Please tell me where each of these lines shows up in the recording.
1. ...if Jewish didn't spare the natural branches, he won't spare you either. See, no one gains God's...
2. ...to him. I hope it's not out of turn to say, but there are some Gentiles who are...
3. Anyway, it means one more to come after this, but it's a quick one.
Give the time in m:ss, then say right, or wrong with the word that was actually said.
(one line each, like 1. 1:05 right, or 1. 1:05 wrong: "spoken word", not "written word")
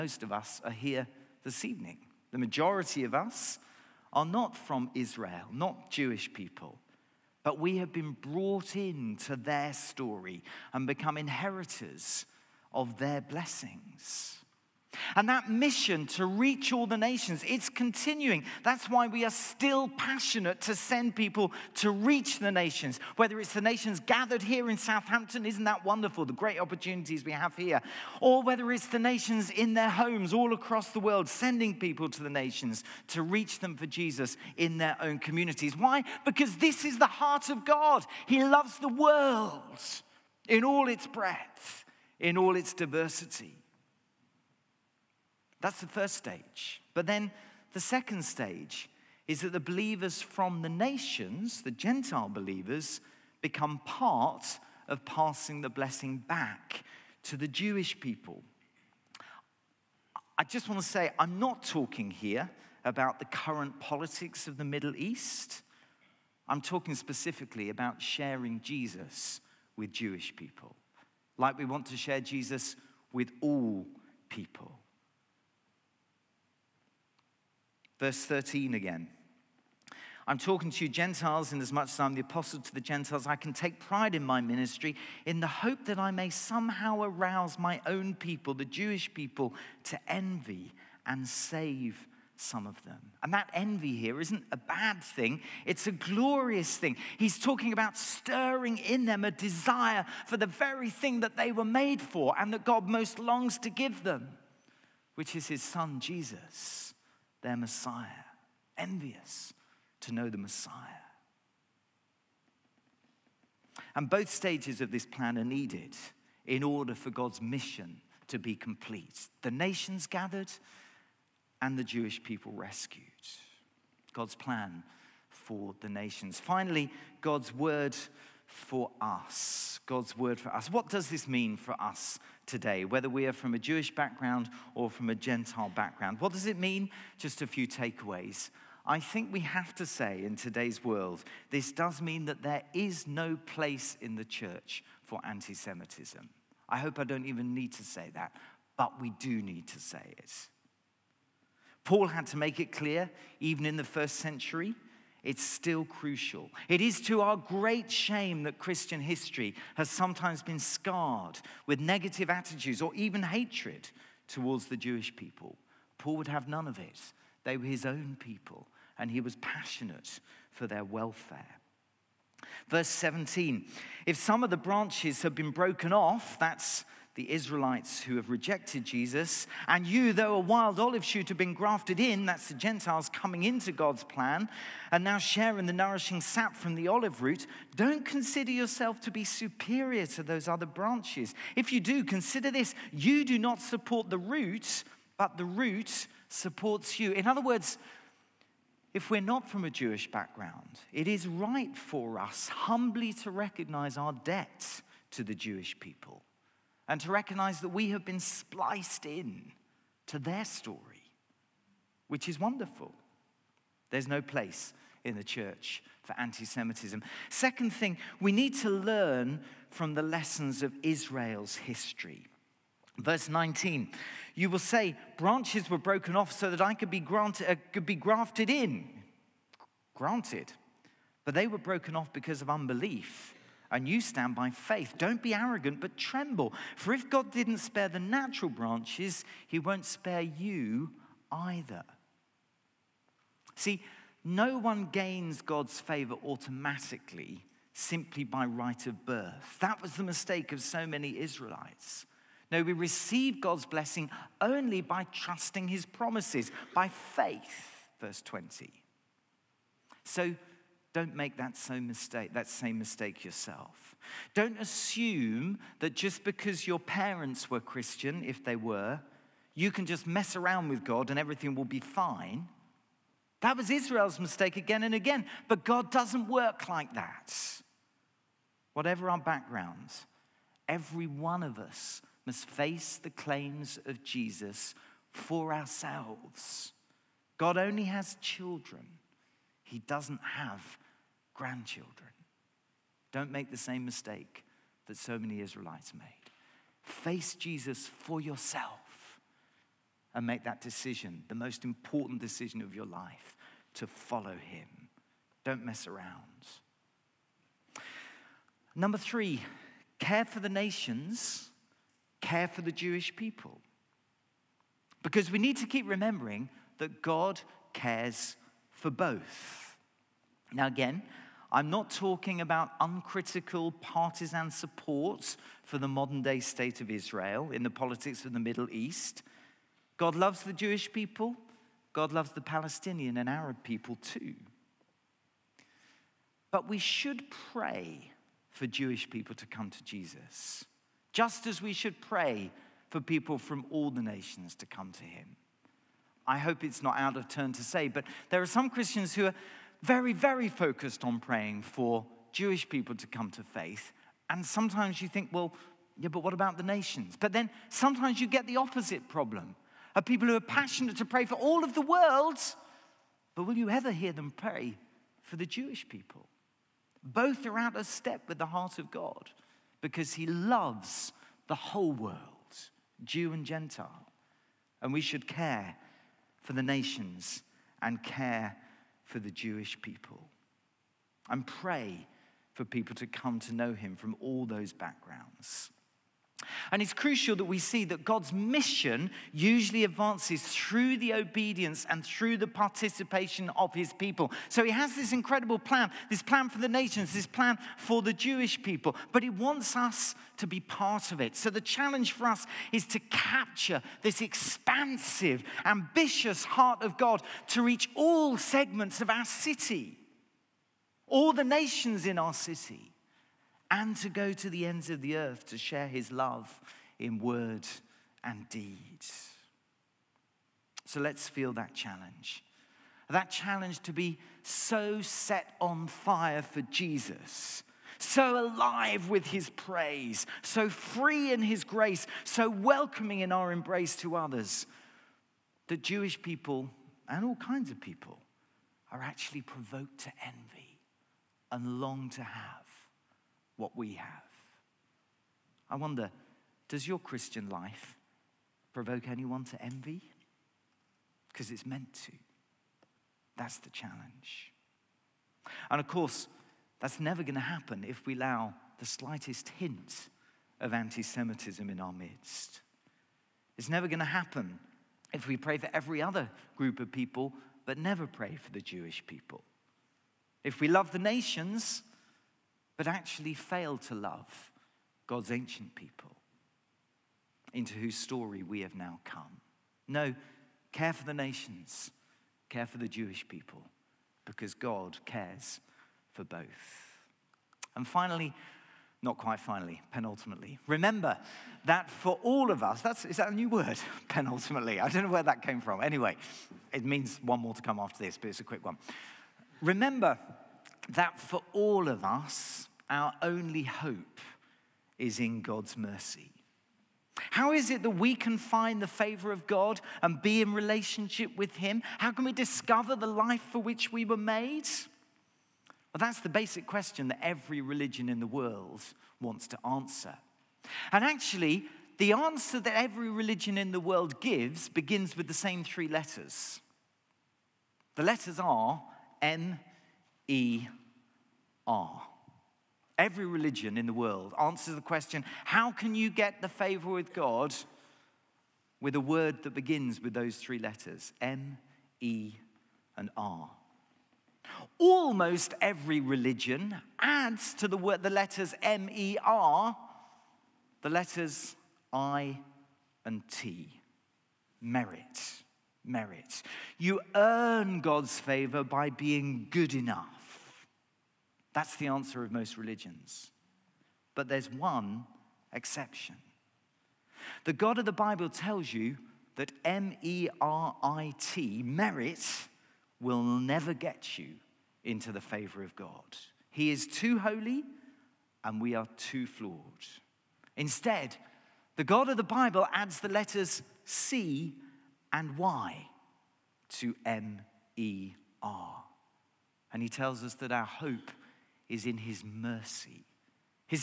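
1. 3:56 wrong: "God", not "Jewish"
2. 5:44 wrong: "Christians", not "Gentiles"
3. 8:15 right.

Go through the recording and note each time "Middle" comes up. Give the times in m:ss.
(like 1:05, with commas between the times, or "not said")
1:04, 5:28.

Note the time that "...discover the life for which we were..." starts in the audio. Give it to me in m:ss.
8:32.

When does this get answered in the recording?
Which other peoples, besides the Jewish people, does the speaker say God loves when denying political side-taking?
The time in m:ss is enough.
5:32.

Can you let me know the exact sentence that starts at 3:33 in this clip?
There's no place in the church for anti Semitism.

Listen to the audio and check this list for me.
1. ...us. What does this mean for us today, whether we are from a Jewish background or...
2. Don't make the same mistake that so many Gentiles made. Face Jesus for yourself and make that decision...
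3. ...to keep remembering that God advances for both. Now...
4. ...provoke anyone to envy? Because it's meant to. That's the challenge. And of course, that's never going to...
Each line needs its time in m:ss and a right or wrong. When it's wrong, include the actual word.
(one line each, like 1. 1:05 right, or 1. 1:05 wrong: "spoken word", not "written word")
1. 2:10 right
2. 4:53 wrong: "Israelites", not "Gentiles"
3. 5:15 wrong: "cares", not "advances"
4. 7:28 right.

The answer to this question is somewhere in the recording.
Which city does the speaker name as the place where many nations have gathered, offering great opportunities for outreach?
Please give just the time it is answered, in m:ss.
0:24.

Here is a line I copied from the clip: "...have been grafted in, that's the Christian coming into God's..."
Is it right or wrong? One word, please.
wrong.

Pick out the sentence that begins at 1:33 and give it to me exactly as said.
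And that envy here isn't a bad thing, it's a glorious thing.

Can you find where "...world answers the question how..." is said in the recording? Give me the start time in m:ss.
8:53.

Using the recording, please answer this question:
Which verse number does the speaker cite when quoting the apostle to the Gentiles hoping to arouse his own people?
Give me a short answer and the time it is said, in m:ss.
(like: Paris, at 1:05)
13, at 1:17.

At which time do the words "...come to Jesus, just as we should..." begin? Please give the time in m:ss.
5:39.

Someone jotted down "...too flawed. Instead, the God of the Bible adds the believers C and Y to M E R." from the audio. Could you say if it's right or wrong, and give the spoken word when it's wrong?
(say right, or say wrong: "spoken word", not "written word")
wrong: "letters", not "believers".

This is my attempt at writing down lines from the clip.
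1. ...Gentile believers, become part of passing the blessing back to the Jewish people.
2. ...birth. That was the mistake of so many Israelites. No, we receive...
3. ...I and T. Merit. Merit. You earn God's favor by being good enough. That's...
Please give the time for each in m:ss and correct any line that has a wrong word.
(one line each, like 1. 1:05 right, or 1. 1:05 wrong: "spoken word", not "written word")
1. 0:51 right
2. 4:09 right
3. 9:11 right.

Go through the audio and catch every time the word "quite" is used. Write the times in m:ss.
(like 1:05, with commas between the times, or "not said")
8:09.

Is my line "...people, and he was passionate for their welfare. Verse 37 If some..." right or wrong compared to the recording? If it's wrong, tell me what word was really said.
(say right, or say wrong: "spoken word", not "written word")
wrong: "17", not "37".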